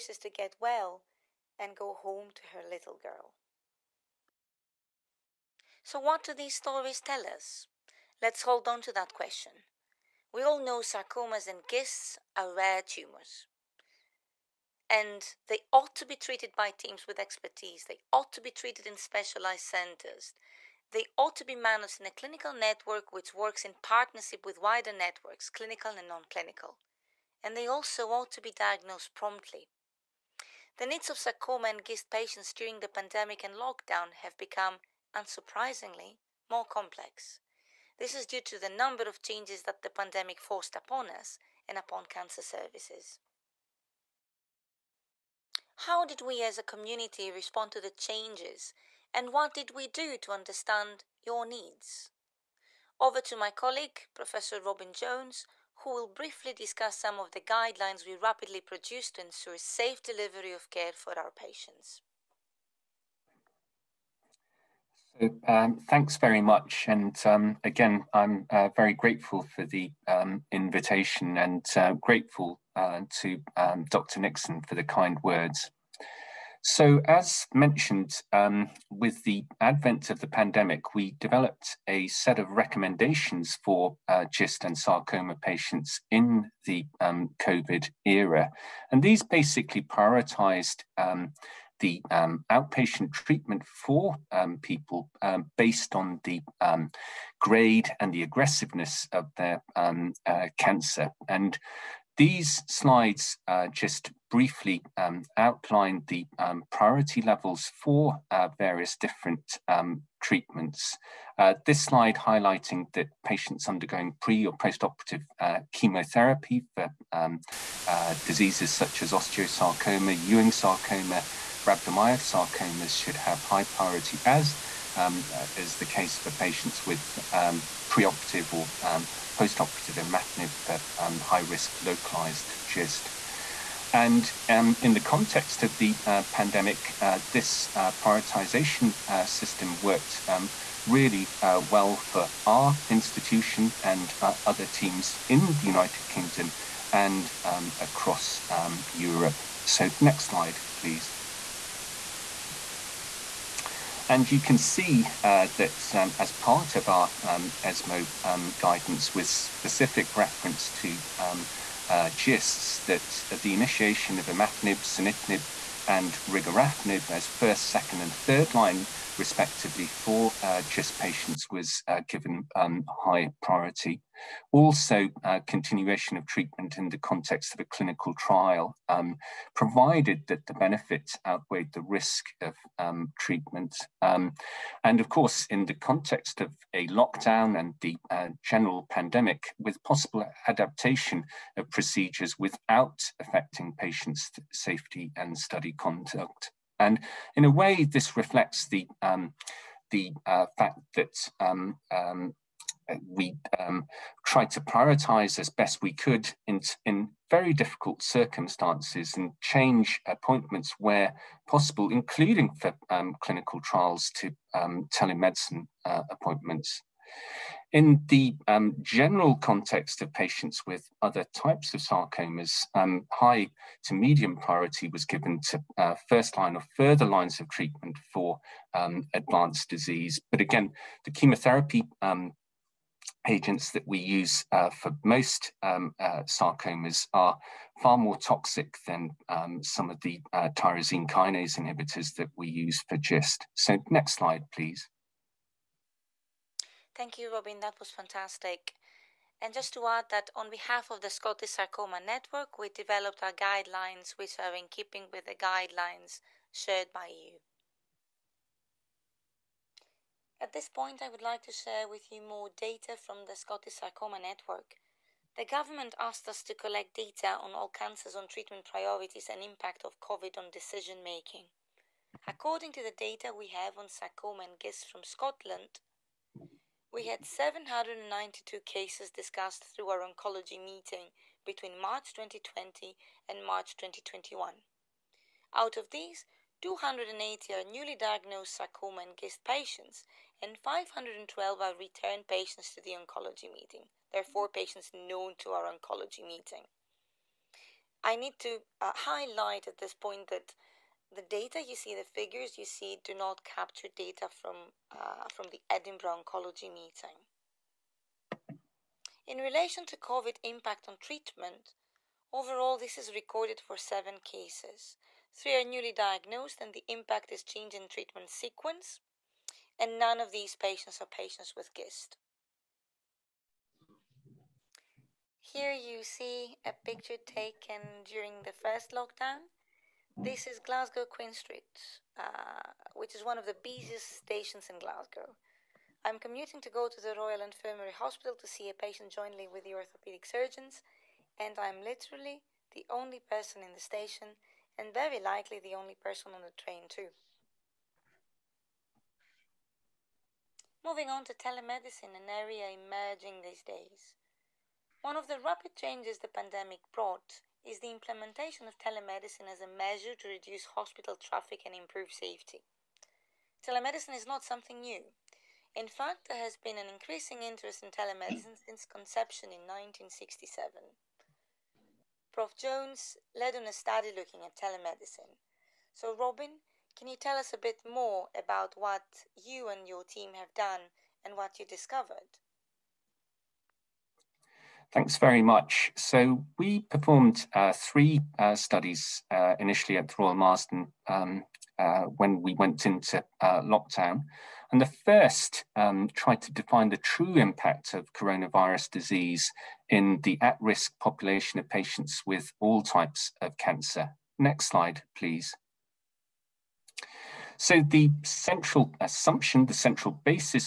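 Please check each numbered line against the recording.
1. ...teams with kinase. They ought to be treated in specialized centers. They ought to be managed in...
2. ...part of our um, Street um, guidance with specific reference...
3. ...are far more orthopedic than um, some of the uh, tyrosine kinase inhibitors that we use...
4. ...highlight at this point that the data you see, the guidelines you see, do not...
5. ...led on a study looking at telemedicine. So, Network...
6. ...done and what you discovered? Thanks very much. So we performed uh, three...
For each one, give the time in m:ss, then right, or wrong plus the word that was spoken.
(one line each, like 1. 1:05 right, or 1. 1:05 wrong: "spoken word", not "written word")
1. 0:16 wrong: "expertise", not "kinase"
2. 2:36 wrong: "ESMO", not "Street"
3. 3:57 wrong: "toxic", not "orthopedic"
4. 4:58 wrong: "figures", not "guidelines"
5. 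6:13 wrong: "Robin", not "Network"
6. 6:20 right.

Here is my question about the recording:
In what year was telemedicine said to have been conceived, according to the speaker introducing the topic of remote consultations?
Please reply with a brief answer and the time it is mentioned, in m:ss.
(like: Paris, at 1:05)
1967, at 6:09.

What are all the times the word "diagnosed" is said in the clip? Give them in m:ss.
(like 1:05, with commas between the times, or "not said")
0:28, 4:47, 5:15.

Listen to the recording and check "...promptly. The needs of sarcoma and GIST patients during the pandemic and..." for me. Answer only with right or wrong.
right.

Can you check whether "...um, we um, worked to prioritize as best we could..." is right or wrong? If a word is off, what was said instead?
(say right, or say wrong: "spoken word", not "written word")
wrong: "tried", not "worked".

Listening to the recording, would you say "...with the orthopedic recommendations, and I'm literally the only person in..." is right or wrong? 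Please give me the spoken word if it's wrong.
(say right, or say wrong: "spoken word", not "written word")
wrong: "surgeons", not "recommendations".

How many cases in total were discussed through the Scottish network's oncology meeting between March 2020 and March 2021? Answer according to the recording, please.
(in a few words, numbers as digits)
792.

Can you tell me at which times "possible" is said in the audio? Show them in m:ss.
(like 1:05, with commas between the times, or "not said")
3:09, 3:31.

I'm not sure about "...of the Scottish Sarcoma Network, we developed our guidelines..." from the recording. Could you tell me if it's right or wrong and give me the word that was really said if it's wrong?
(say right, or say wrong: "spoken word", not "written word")
right.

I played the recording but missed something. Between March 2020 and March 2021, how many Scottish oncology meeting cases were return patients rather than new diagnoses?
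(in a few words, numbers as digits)
512.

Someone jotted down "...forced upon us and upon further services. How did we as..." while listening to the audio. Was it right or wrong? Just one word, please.
wrong.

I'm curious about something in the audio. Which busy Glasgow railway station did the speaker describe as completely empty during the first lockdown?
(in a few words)
Glasgow Queen Street.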